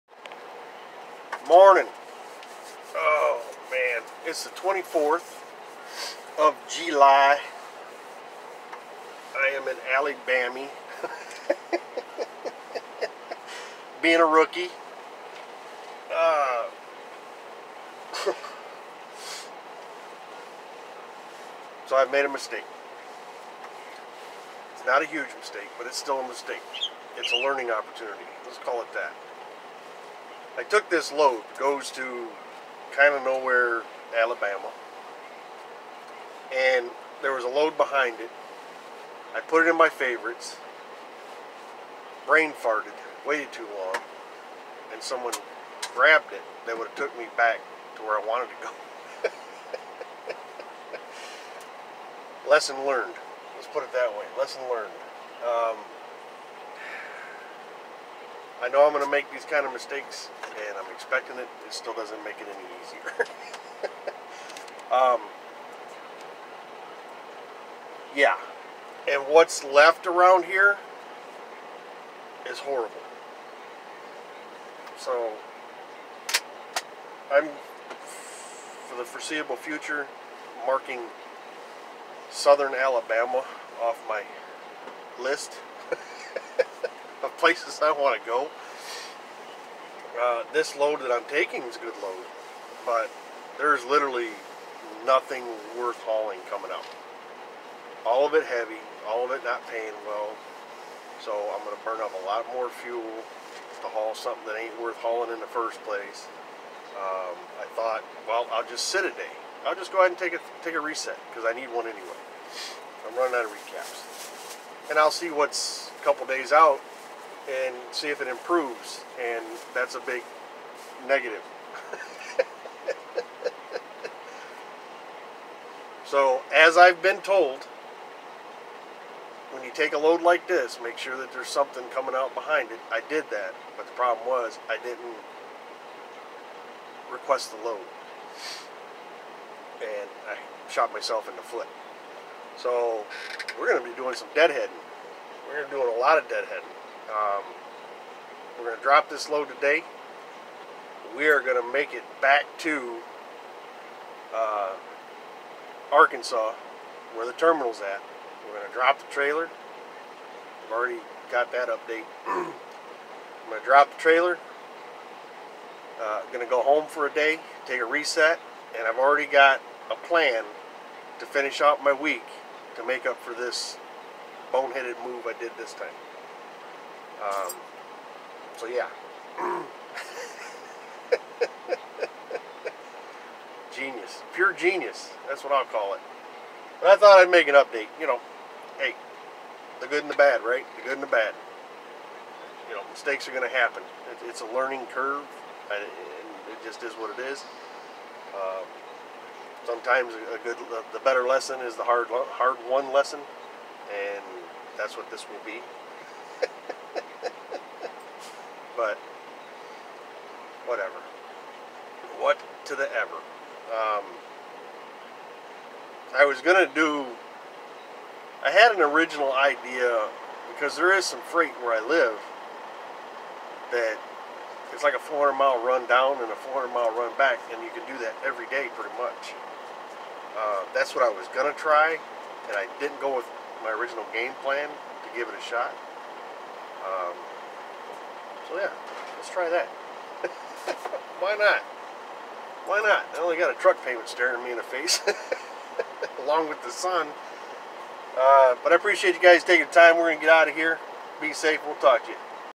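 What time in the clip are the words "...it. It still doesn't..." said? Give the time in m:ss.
1:01.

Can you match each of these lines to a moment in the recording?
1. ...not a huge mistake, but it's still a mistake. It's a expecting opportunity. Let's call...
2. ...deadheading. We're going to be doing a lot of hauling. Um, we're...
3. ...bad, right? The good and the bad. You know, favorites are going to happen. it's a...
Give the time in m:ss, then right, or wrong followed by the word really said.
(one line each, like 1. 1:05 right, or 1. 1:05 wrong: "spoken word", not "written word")
1. 0:24 wrong: "learning", not "expecting"
2. 2:24 wrong: "deadheading", not "hauling"
3. 3:10 wrong: "mistakes", not "favorites".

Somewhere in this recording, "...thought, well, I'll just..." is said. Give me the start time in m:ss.
1:47.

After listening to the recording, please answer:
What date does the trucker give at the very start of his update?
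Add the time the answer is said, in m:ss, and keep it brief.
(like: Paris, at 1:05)
July 24, at 0:04.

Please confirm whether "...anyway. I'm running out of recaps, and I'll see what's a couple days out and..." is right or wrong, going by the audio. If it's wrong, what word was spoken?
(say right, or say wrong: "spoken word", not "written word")
right.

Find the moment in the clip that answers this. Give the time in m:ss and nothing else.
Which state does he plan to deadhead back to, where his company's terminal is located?
2:35.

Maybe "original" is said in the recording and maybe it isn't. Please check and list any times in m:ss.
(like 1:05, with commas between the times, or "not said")
3:38, 3:53.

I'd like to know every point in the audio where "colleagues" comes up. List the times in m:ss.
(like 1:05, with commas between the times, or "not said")
not said.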